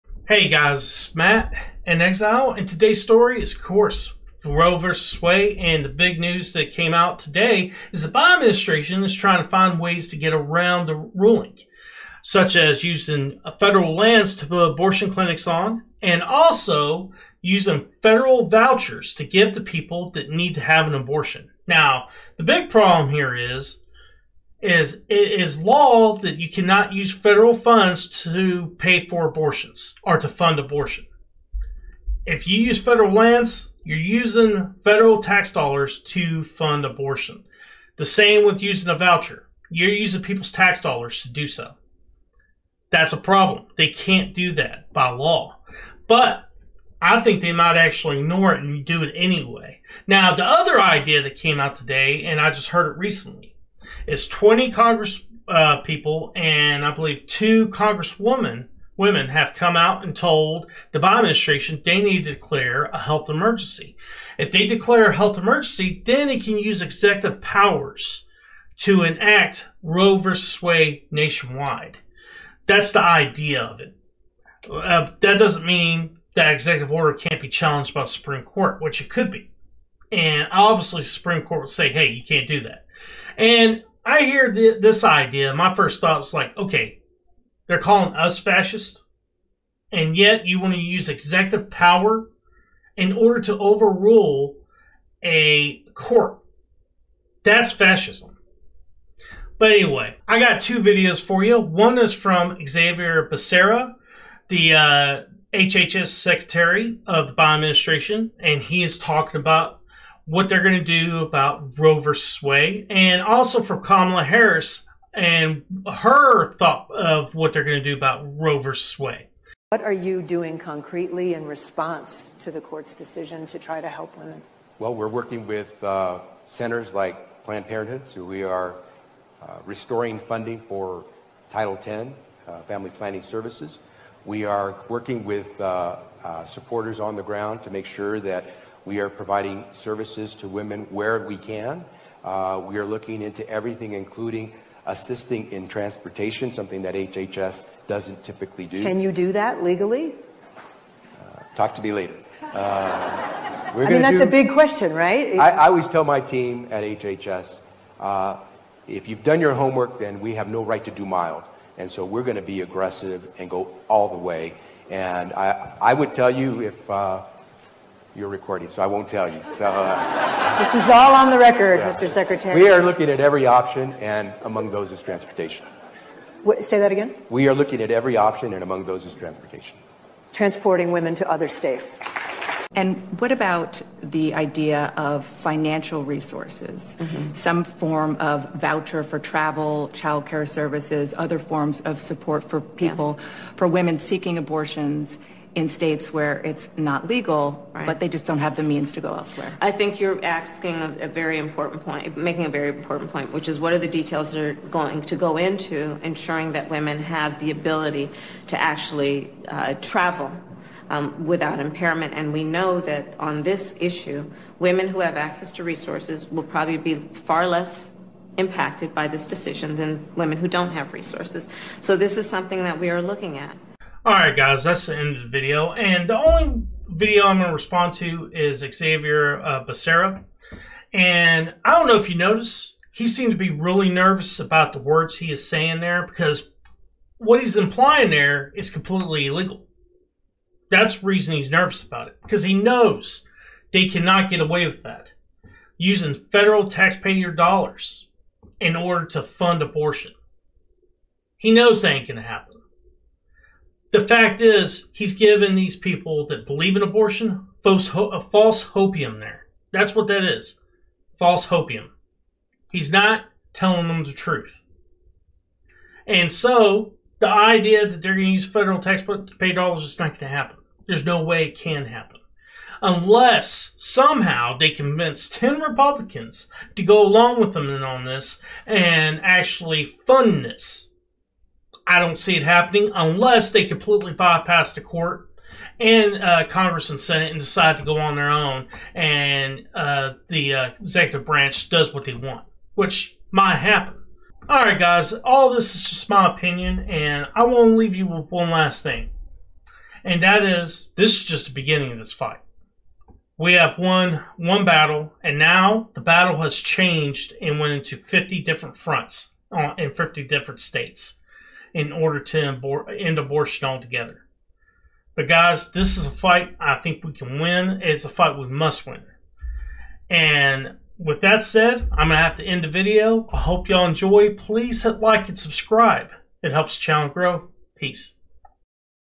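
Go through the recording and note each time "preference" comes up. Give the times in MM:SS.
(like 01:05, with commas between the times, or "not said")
not said.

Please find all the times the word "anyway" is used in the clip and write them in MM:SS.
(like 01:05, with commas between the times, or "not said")
00:49, 01:39.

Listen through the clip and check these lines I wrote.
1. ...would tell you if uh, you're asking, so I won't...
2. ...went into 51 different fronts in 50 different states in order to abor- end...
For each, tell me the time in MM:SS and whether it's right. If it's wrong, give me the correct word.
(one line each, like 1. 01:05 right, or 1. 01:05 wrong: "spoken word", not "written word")
1. 02:45 wrong: "recording", not "asking"
2. 05:07 wrong: "50", not "51".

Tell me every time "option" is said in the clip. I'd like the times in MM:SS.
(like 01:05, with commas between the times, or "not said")
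02:53, 02:58.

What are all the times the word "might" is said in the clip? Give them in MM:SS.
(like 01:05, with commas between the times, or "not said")
00:47, 04:53.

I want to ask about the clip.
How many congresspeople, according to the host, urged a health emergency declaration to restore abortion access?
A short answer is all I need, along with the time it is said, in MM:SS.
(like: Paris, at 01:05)
20, at 00:54.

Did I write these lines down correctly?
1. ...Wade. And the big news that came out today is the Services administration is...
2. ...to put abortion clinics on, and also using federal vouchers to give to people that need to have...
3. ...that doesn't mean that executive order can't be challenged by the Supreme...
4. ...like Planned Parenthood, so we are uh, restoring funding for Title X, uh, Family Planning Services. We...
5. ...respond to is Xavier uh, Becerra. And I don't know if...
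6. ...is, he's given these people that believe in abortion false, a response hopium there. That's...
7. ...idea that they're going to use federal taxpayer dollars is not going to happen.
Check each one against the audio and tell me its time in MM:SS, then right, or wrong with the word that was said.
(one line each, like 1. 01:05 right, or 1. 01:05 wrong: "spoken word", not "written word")
1. 00:05 wrong: "Biden", not "Services"
2. 00:14 right
3. 01:15 right
4. 02:06 right
5. 03:47 right
6. 04:14 wrong: "false", not "response"
7. 04:27 right.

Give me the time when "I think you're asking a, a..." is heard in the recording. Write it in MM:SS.
03:19.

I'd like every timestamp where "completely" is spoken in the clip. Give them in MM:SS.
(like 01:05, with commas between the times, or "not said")
03:58, 04:43.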